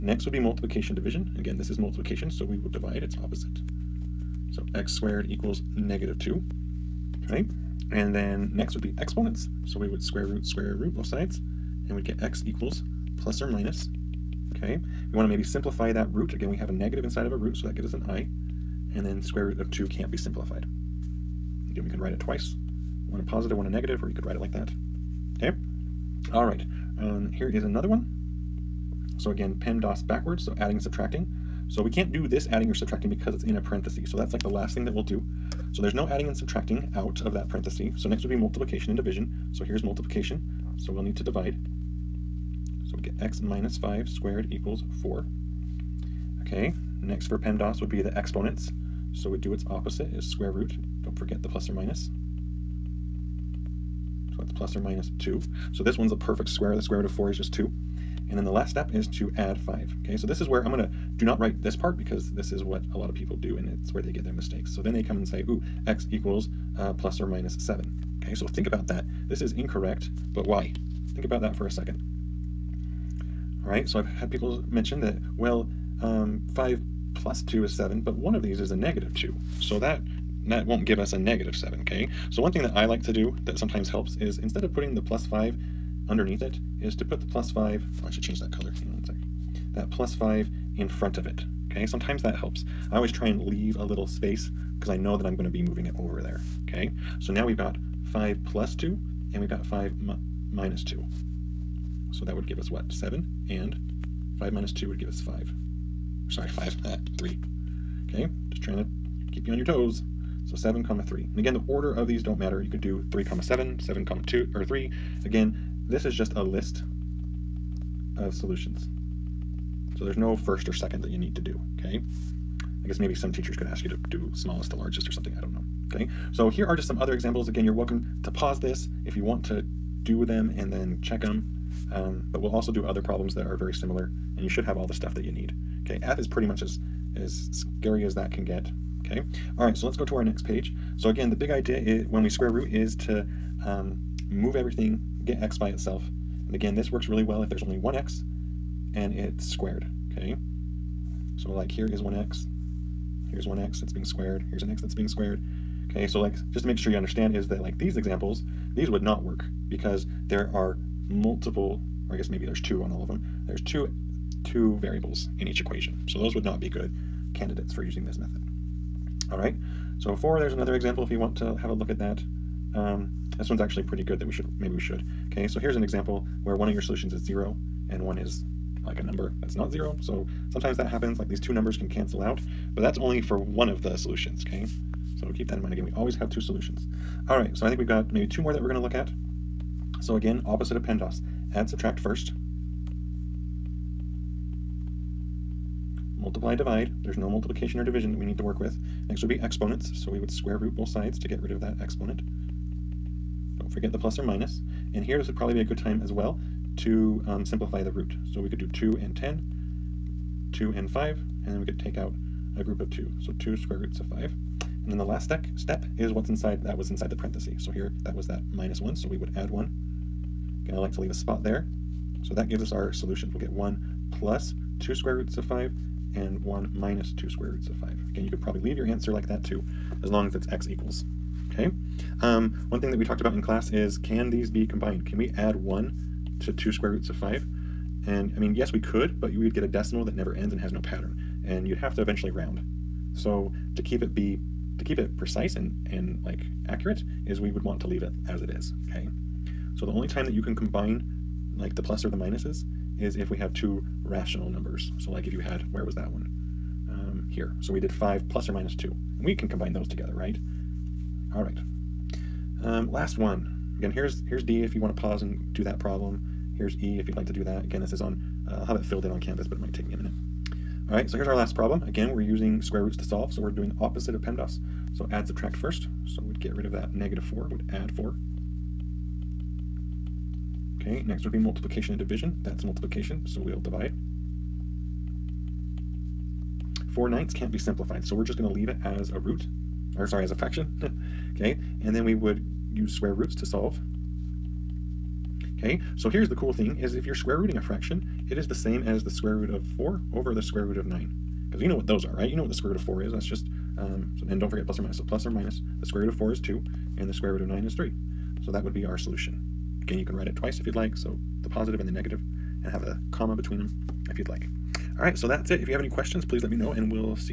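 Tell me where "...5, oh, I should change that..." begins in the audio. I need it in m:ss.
1:27.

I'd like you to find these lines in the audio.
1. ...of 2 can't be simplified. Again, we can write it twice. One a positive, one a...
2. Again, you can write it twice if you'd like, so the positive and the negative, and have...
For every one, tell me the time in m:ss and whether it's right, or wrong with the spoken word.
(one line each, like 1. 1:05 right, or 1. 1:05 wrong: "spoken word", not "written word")
1. 0:19 right
2. 5:09 right.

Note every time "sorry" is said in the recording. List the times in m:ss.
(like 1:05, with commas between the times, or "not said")
1:46, 4:50.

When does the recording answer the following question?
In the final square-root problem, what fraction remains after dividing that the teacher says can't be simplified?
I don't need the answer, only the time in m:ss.
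4:46.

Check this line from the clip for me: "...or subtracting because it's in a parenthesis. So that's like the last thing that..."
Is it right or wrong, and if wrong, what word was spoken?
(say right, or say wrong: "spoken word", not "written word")
right.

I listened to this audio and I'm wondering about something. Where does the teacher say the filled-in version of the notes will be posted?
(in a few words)
Canvas.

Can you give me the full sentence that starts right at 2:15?
Okay, F is pretty much as, as scary as that can get.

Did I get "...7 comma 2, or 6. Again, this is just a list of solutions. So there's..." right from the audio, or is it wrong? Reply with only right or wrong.
wrong.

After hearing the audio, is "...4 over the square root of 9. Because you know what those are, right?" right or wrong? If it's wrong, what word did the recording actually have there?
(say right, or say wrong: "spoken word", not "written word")
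right.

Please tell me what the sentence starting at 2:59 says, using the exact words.
So sometimes that happens, like these two numbers can cancel out.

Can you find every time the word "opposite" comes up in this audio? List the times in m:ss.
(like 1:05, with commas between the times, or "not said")
0:03, 0:49, 3:10, 4:33.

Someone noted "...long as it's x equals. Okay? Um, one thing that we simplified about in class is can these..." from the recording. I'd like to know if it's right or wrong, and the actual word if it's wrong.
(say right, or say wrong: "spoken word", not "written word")
wrong: "talked", not "simplified".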